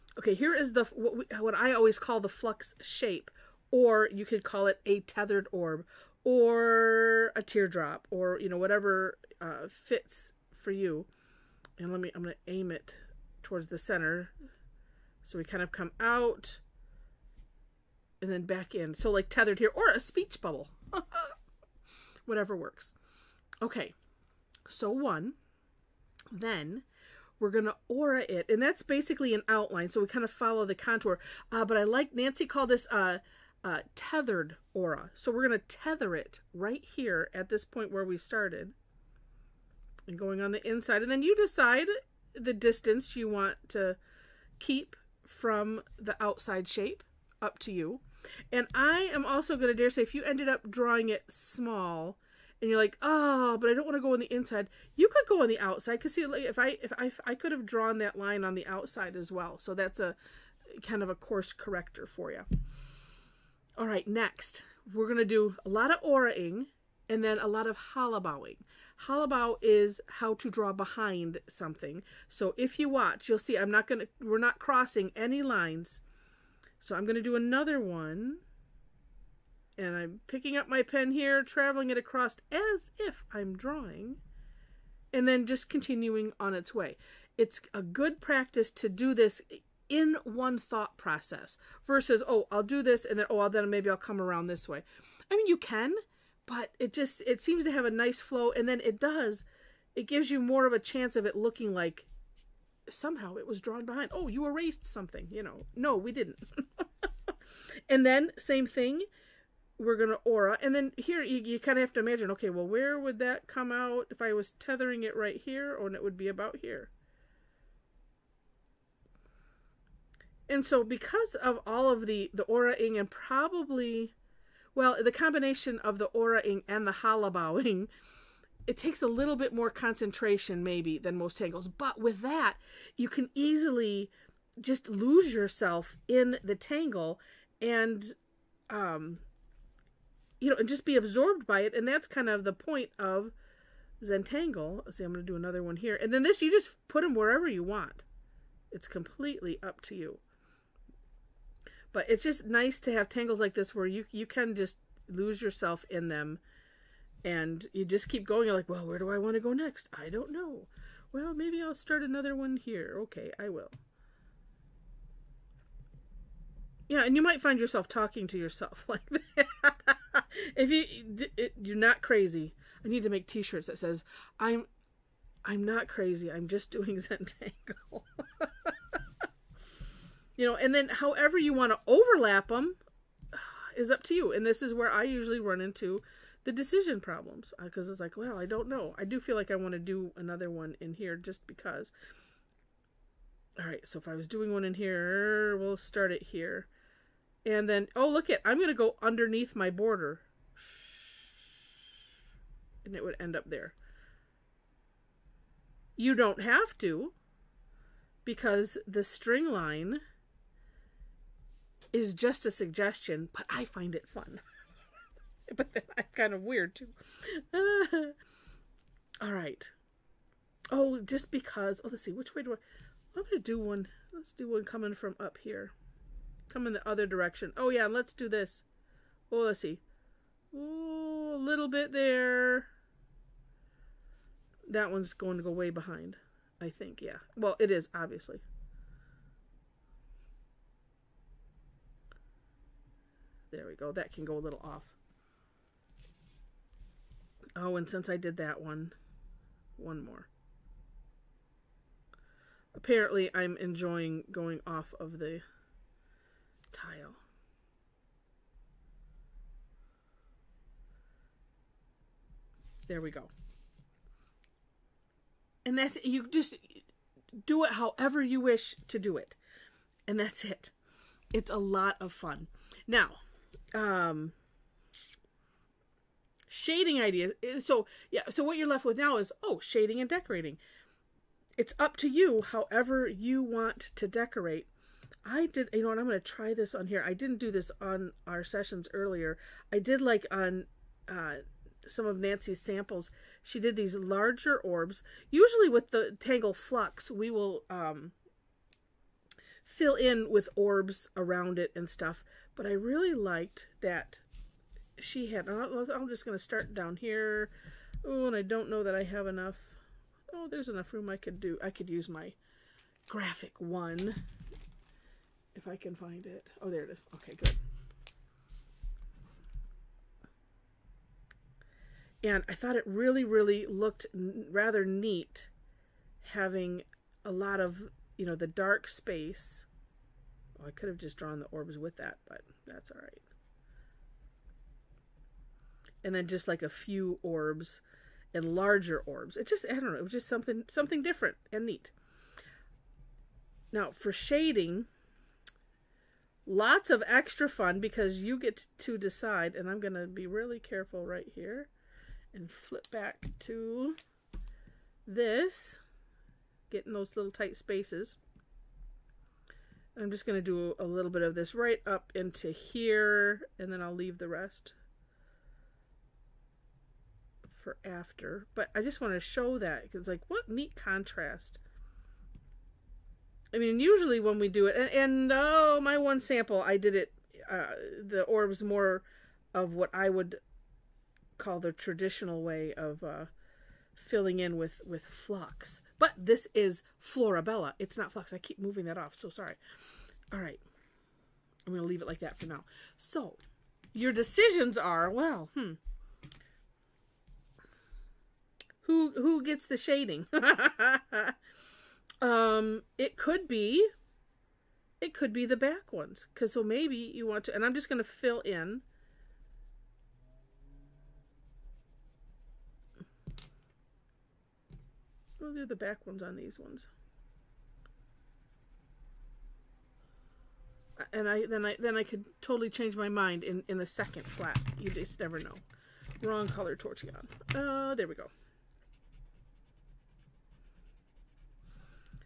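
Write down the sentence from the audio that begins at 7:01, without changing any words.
And I then I then I could totally change my mind in in a second flat.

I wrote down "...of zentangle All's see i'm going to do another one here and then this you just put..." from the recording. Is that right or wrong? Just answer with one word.
wrong.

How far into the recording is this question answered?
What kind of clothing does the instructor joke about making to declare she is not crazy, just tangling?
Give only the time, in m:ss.
2:53.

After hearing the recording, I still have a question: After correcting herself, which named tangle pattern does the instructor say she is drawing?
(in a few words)
Florabella.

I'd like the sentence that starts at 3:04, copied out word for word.
And this is where I usually run into the decision problems because uh, it's like, well, I don't know.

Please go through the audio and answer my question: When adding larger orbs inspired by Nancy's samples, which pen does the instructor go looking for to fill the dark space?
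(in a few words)
Graphic one.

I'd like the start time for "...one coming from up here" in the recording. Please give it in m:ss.
3:44.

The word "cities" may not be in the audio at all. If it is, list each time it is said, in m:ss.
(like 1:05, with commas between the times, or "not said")
not said.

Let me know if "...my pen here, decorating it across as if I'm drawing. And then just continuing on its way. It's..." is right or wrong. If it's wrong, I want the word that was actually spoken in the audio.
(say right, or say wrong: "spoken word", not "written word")
wrong: "traveling", not "decorating".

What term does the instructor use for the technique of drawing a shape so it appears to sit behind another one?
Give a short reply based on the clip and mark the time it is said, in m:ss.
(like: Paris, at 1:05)
Hollibaugh, at 1:09.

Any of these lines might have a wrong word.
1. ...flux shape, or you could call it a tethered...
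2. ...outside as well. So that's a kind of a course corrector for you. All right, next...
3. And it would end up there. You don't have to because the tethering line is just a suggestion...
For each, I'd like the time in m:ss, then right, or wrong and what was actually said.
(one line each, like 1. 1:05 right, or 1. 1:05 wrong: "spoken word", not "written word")
1. 0:02 right
2. 0:58 right
3. 3:22 wrong: "string", not "tethering".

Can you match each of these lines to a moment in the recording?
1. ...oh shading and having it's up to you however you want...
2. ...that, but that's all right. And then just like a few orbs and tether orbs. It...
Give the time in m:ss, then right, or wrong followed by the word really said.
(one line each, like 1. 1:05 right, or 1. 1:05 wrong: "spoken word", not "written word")
1. 4:39 wrong: "decorating", not "having"
2. 5:31 wrong: "larger", not "tether".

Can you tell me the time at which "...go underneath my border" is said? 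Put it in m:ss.
3:18.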